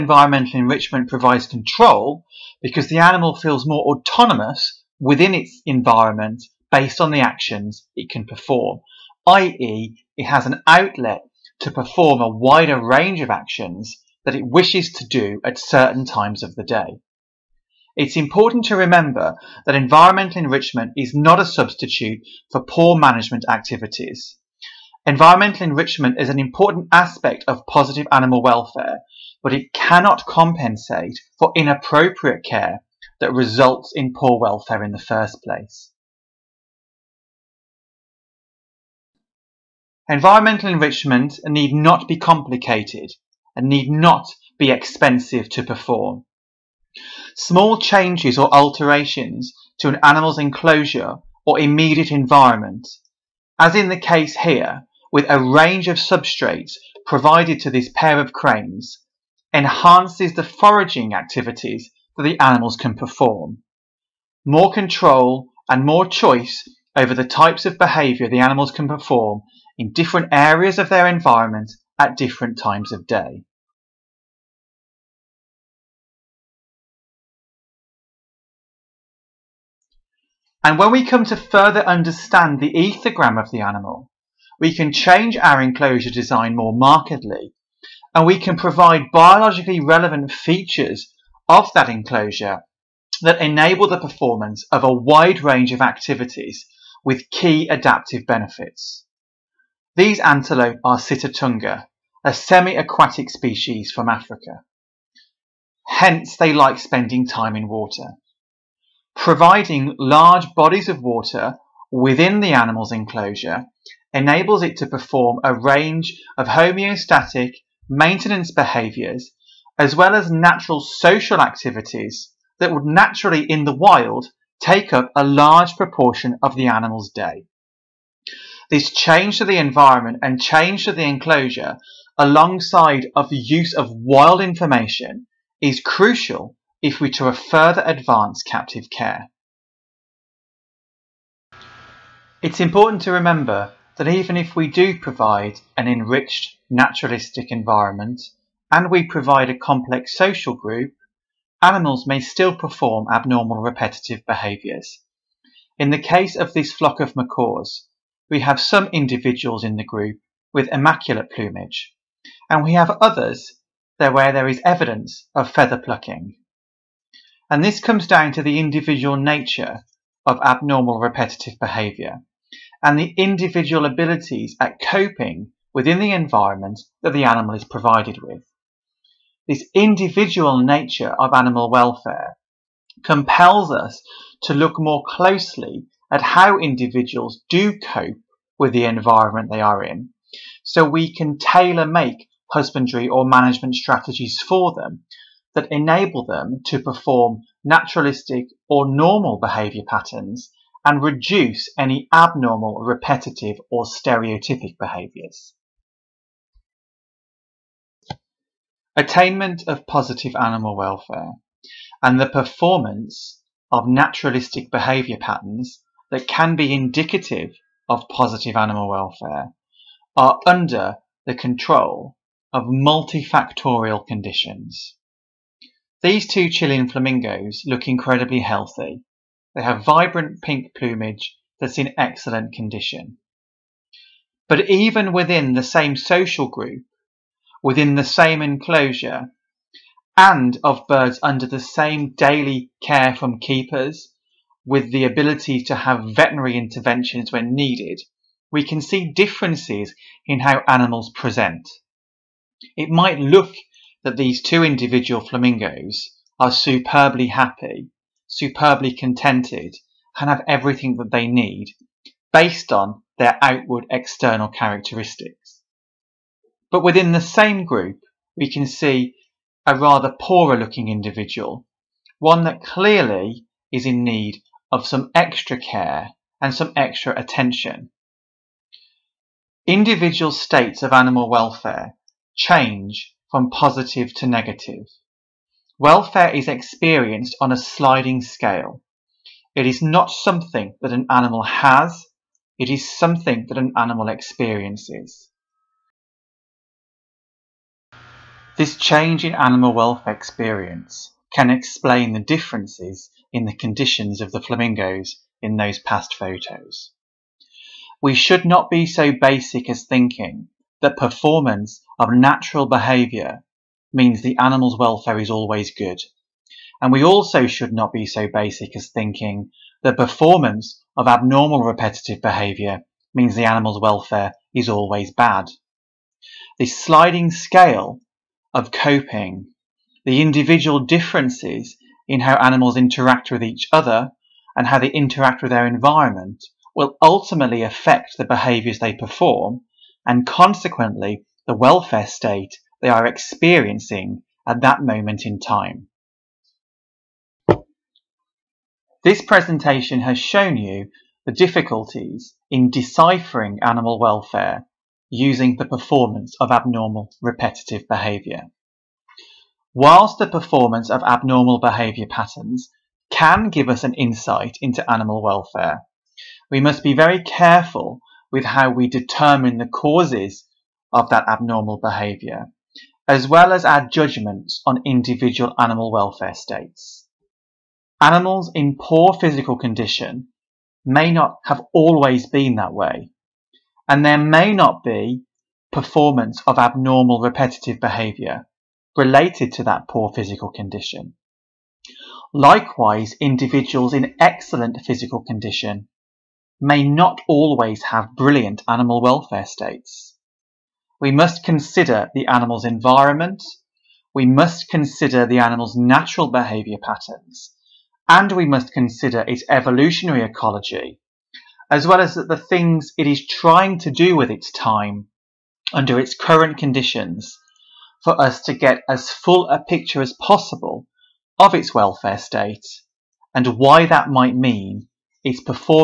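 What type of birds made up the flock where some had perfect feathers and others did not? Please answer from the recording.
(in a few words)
Macaws.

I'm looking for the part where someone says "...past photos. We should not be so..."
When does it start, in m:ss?
5:05.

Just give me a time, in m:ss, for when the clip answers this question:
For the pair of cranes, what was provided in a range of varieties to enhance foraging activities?
0:56.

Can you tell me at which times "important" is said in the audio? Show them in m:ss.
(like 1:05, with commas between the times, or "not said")
0:18, 0:26, 2:22.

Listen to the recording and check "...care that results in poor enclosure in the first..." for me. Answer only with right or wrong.
wrong.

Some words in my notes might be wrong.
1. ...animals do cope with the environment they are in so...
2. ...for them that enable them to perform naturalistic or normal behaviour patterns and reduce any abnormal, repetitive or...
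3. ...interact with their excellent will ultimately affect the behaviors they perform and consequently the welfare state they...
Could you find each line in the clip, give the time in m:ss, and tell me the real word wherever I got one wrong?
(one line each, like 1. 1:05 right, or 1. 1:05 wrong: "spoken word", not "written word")
1. 3:06 wrong: "individuals", not "animals"
2. 3:14 right
3. 5:34 wrong: "environment", not "excellent".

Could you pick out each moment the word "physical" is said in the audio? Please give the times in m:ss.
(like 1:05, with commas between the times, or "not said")
6:19, 6:30, 6:34.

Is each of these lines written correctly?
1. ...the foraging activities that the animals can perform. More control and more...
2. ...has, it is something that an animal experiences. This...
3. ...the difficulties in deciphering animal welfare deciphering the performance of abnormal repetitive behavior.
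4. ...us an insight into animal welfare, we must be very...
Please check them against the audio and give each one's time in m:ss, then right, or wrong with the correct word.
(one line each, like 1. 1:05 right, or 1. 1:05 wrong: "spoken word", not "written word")
1. 1:00 right
2. 4:51 right
3. 5:51 wrong: "using", not "deciphering"
4. 6:03 right.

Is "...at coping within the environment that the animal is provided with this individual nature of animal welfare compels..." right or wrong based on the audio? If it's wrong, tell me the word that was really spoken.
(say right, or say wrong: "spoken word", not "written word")
right.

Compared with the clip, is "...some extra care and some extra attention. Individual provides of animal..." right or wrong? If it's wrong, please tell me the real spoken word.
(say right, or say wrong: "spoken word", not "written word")
wrong: "states", not "provides".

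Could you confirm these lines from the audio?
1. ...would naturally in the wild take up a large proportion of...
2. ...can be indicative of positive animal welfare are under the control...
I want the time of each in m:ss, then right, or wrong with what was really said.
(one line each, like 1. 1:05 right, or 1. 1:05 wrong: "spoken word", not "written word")
1. 2:02 right
2. 3:36 right.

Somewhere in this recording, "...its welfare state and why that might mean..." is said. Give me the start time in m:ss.
7:01.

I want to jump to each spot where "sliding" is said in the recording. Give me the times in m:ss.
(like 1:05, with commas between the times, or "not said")
4:47, 5:26.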